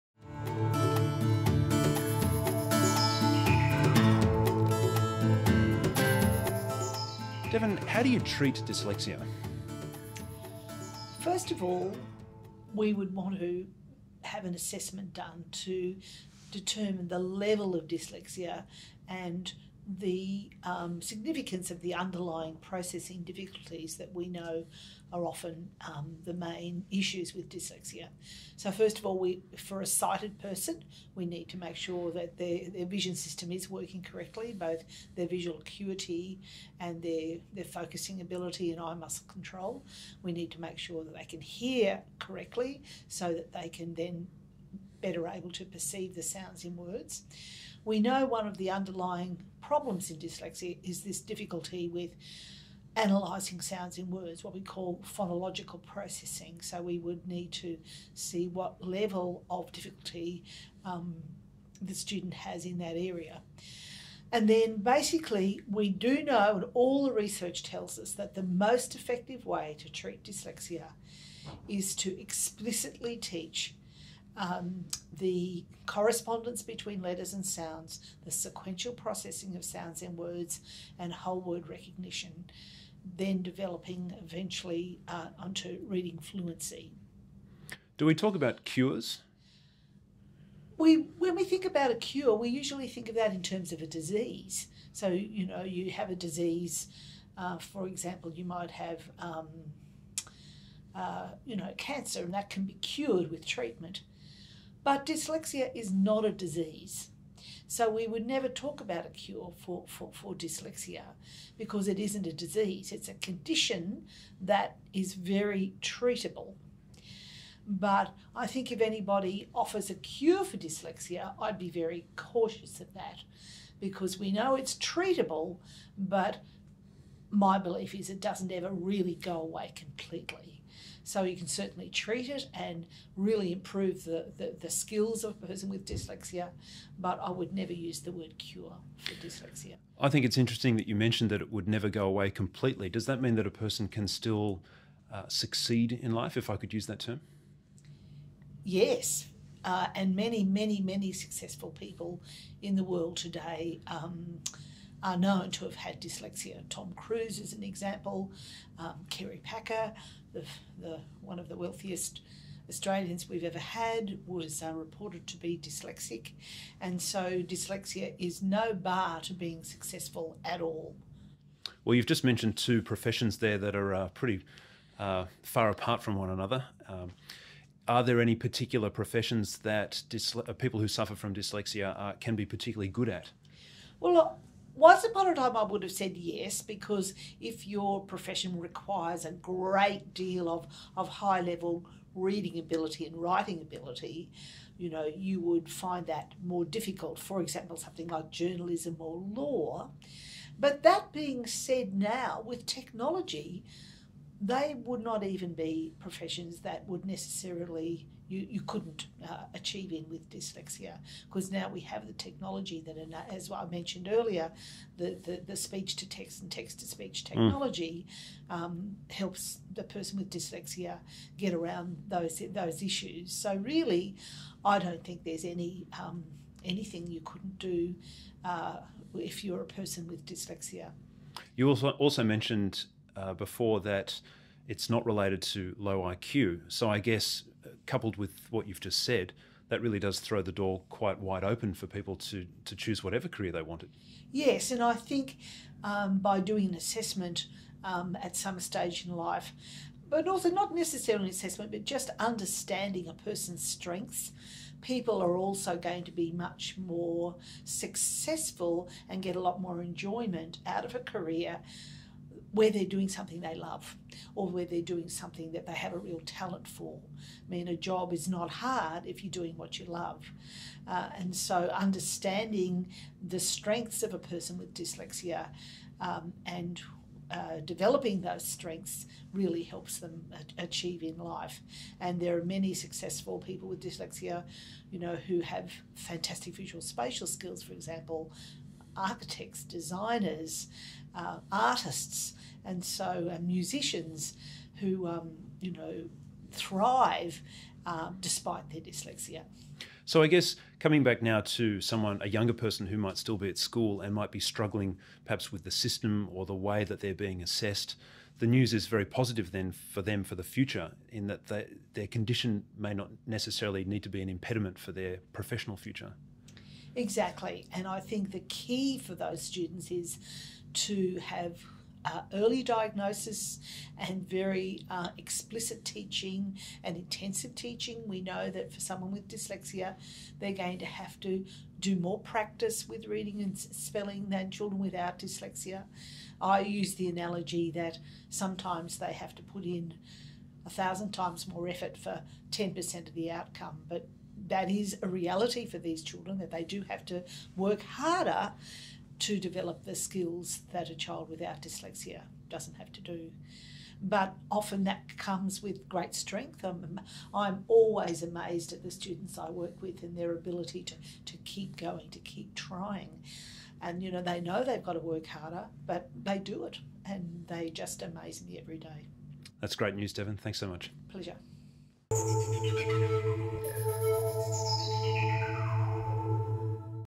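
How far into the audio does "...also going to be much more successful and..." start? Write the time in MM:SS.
04:15.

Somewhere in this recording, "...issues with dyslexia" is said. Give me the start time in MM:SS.
00:26.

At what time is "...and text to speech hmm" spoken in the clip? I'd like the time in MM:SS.
03:36.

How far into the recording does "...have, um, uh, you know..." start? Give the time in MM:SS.
01:38.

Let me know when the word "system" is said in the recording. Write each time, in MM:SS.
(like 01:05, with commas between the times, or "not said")
00:33, 05:05.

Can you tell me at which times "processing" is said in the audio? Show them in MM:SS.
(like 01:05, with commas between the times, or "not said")
00:22, 00:55, 01:18.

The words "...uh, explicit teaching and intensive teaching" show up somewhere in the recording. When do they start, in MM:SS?
05:24.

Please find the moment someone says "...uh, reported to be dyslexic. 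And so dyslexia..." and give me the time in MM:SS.
02:44.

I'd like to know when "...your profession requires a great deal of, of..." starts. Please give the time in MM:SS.
03:07.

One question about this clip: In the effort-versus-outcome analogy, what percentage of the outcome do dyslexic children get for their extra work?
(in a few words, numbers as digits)
10%.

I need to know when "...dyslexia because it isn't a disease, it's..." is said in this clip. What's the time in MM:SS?
01:50.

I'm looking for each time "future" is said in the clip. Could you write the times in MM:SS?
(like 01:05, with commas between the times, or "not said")
05:10, 05:15.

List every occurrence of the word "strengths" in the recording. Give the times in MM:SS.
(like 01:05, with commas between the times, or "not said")
04:13, 04:33, 04:38, 05:56.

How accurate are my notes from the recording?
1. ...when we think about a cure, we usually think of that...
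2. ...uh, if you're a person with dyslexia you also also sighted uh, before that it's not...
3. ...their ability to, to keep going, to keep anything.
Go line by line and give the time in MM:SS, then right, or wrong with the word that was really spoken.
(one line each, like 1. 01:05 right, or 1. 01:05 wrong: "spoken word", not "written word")
1. 01:31 right
2. 03:48 wrong: "mentioned", not "sighted"
3. 06:00 wrong: "trying", not "anything".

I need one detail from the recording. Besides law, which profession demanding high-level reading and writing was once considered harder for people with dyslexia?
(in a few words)
journalism.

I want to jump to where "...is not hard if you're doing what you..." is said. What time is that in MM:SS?
04:28.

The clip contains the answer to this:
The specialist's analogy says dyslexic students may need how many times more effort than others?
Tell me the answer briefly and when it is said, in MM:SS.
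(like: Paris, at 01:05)
1000 times, at 05:40.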